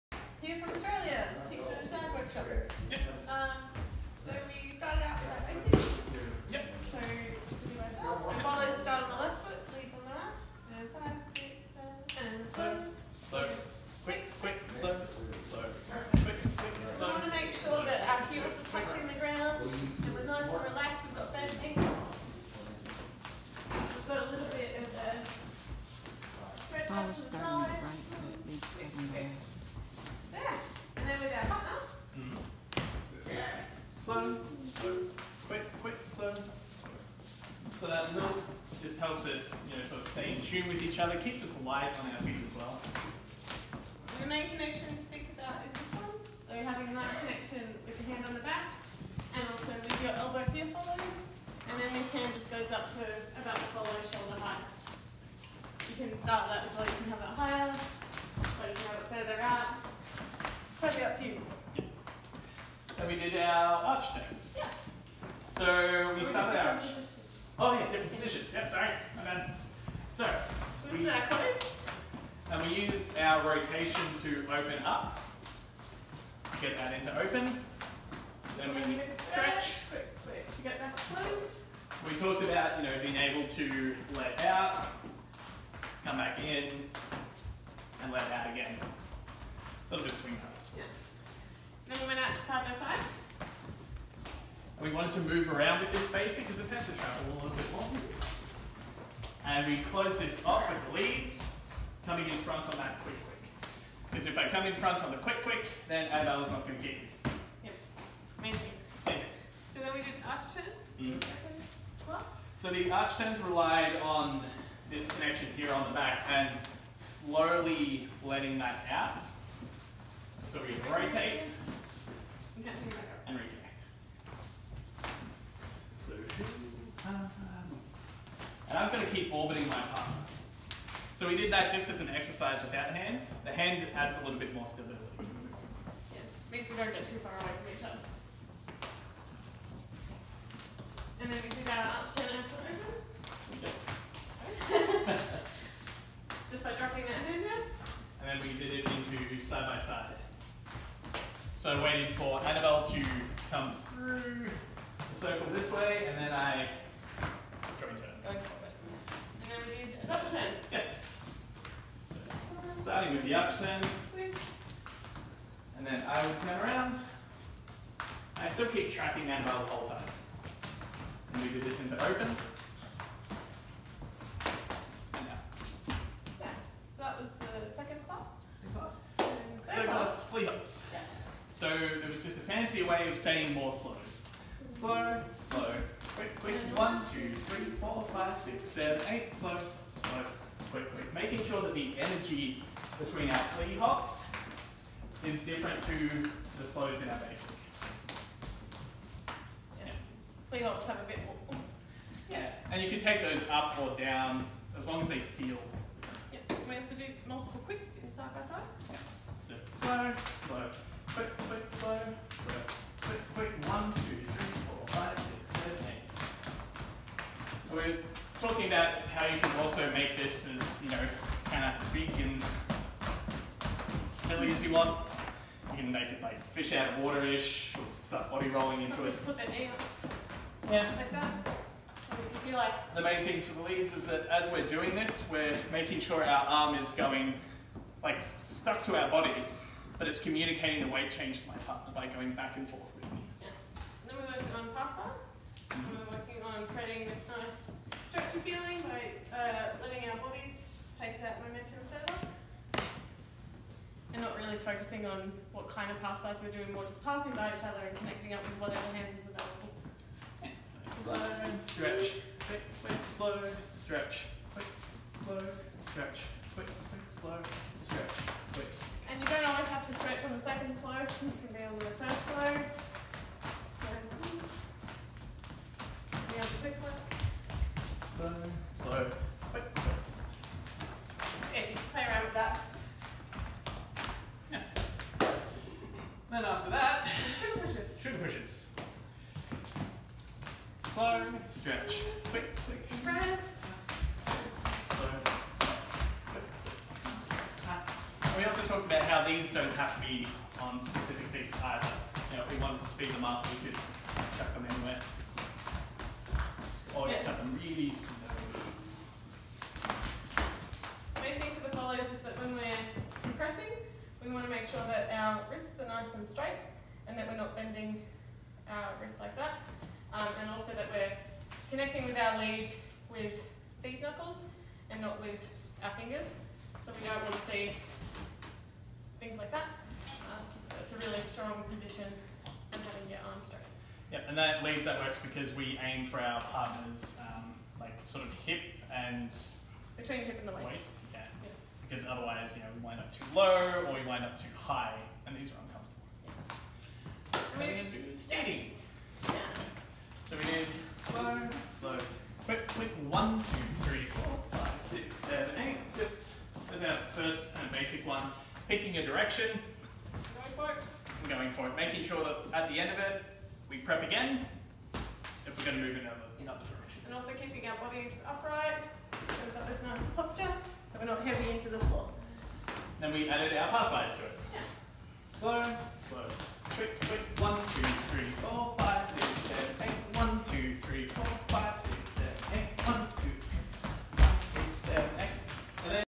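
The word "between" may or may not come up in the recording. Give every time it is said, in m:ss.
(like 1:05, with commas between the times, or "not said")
3:12, 5:39.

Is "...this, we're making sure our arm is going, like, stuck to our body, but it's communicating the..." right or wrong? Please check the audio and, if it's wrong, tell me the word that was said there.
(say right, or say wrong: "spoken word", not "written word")
right.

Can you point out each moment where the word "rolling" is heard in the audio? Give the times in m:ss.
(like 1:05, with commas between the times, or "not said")
3:48.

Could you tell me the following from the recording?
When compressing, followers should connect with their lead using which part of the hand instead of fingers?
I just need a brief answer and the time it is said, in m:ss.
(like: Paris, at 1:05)
Knuckles, at 5:24.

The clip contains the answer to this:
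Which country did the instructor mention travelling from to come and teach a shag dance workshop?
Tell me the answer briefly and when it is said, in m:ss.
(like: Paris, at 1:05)
Australia, at 0:00.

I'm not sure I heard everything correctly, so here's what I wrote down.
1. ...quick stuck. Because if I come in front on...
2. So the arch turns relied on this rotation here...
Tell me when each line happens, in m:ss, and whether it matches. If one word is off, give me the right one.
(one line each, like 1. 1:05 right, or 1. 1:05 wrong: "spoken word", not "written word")
1. 1:43 wrong: "quick", not "stuck"
2. 1:52 wrong: "connection", not "rotation".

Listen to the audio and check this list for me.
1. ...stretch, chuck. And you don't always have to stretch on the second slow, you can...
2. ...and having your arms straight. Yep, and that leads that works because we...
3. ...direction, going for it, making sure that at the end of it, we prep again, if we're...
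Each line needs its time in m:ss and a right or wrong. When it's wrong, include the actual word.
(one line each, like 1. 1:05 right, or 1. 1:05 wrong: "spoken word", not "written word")
1. 4:27 wrong: "quick", not "chuck"
2. 5:32 right
3. 5:59 right.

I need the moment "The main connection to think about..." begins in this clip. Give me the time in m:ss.
0:44.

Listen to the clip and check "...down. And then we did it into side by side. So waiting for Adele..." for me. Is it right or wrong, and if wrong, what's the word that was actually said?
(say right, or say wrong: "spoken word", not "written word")
wrong: "Annabel", not "Adele".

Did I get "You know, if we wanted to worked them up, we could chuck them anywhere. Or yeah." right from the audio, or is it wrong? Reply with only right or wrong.
wrong.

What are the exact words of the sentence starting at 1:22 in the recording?
We talked about, you know, being able to let out, come back in, and let out again.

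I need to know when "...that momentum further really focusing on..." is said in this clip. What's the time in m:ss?
4:11.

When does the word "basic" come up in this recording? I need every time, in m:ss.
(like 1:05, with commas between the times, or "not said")
1:36, 3:17, 5:57.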